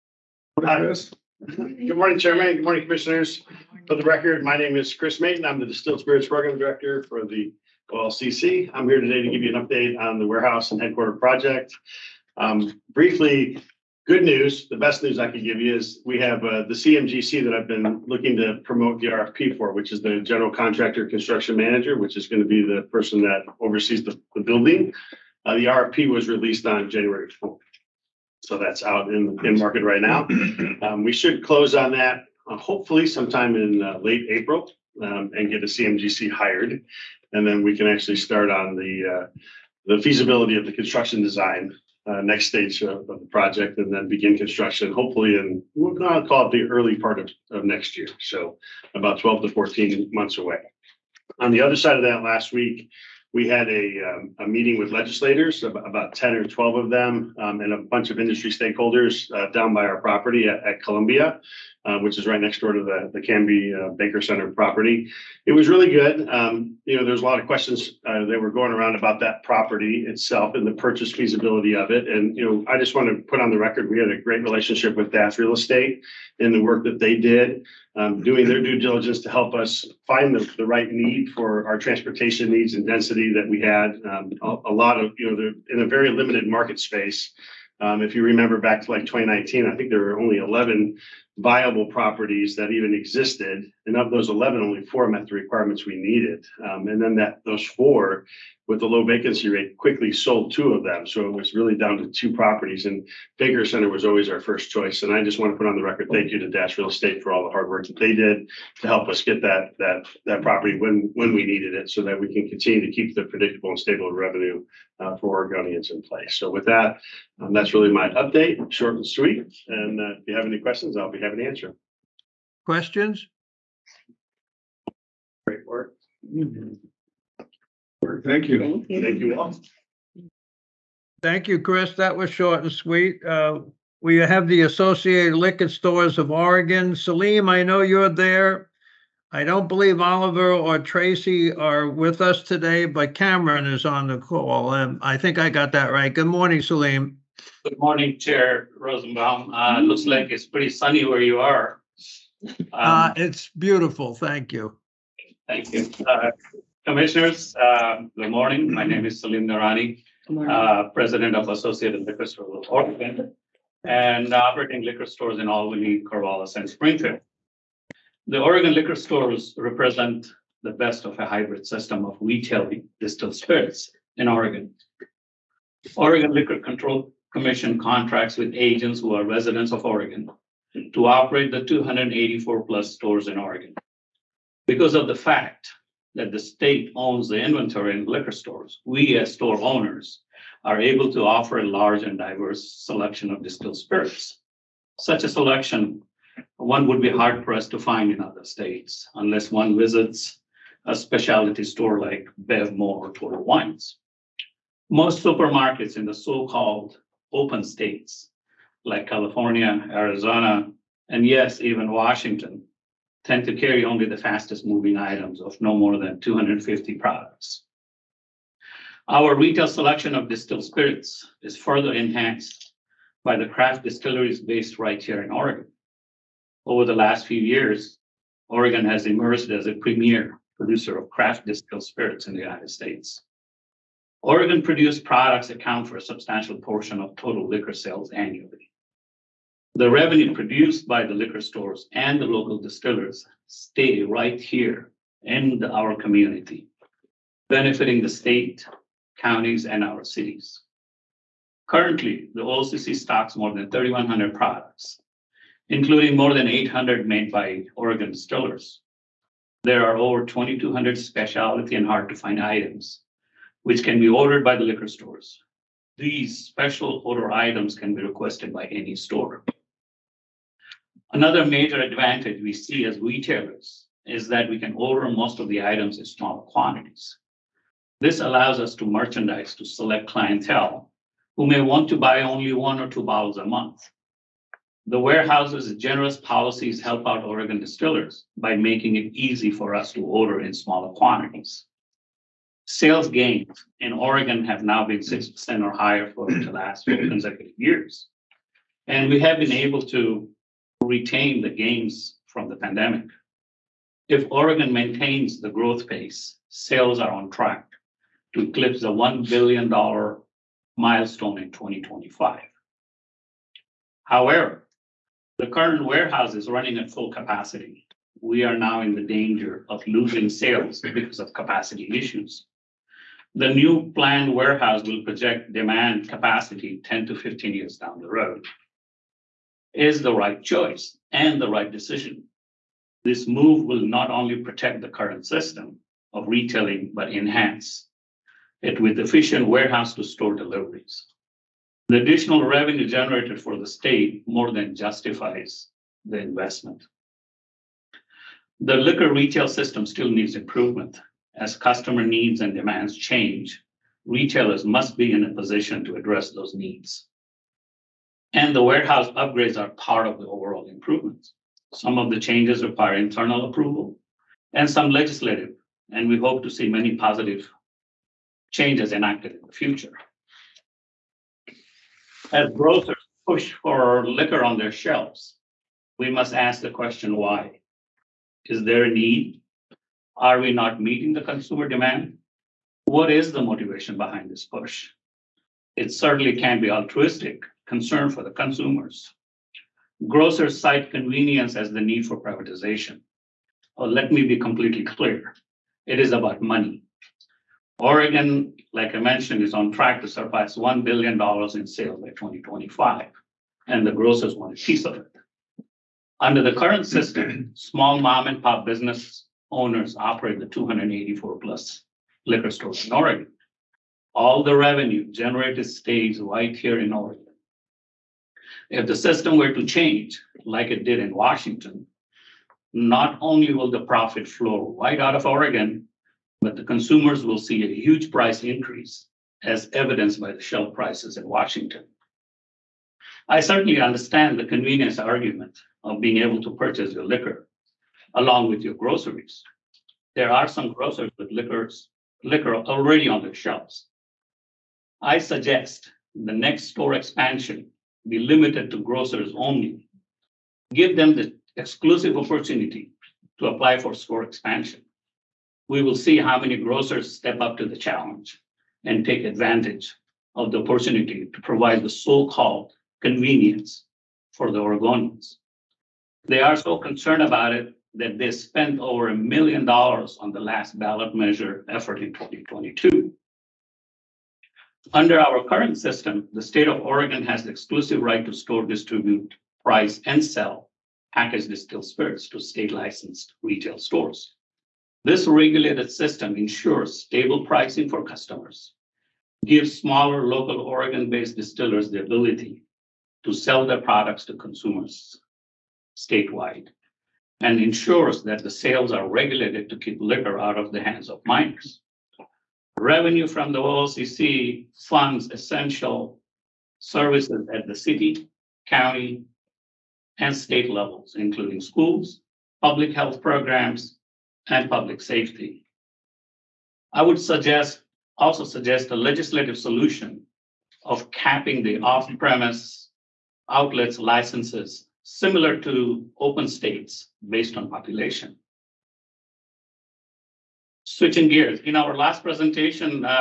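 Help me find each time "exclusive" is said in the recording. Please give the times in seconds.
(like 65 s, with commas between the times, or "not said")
451 s, 477 s.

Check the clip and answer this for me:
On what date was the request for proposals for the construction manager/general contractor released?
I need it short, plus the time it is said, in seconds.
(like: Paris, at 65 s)
January 4th, at 26 s.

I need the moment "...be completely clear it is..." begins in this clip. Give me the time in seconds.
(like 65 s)
394 s.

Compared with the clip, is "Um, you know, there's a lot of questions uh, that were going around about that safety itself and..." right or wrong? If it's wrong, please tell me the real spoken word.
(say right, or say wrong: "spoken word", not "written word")
wrong: "property", not "safety".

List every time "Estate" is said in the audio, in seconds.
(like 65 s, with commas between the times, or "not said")
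75 s, 106 s.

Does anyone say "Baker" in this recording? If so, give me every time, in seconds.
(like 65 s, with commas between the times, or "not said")
63 s, 103 s.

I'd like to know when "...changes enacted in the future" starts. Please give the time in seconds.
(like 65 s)
368 s.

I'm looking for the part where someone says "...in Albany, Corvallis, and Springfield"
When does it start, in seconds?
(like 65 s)
165 s.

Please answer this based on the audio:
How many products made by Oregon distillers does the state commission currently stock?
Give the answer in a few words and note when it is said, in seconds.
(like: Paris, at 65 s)
more than 800, at 256 s.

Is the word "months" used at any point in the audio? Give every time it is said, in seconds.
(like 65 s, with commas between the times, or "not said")
50 s, 283 s.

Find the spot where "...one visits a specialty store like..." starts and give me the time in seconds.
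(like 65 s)
199 s.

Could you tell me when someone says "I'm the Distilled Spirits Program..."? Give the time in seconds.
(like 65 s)
5 s.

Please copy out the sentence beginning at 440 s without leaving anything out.
There are some grocers with liquors, liquor already on their shelves.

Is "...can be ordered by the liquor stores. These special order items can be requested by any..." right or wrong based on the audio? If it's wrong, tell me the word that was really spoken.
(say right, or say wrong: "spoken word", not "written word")
right.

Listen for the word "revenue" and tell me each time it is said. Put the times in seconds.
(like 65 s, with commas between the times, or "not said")
114 s, 239 s, 342 s, 414 s, 502 s.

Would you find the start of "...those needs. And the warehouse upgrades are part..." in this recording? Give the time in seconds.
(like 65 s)
356 s.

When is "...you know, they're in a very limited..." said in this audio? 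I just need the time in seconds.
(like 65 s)
85 s.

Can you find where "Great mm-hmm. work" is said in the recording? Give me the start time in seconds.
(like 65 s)
125 s.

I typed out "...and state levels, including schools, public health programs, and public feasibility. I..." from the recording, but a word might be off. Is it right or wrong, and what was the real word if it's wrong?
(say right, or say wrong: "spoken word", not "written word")
wrong: "safety", not "feasibility".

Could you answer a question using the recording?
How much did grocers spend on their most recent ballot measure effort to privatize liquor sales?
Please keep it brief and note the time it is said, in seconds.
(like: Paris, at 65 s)
over a million dollars, at 468 s.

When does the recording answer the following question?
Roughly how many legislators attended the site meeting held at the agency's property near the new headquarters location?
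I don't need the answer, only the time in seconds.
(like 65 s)
56 s.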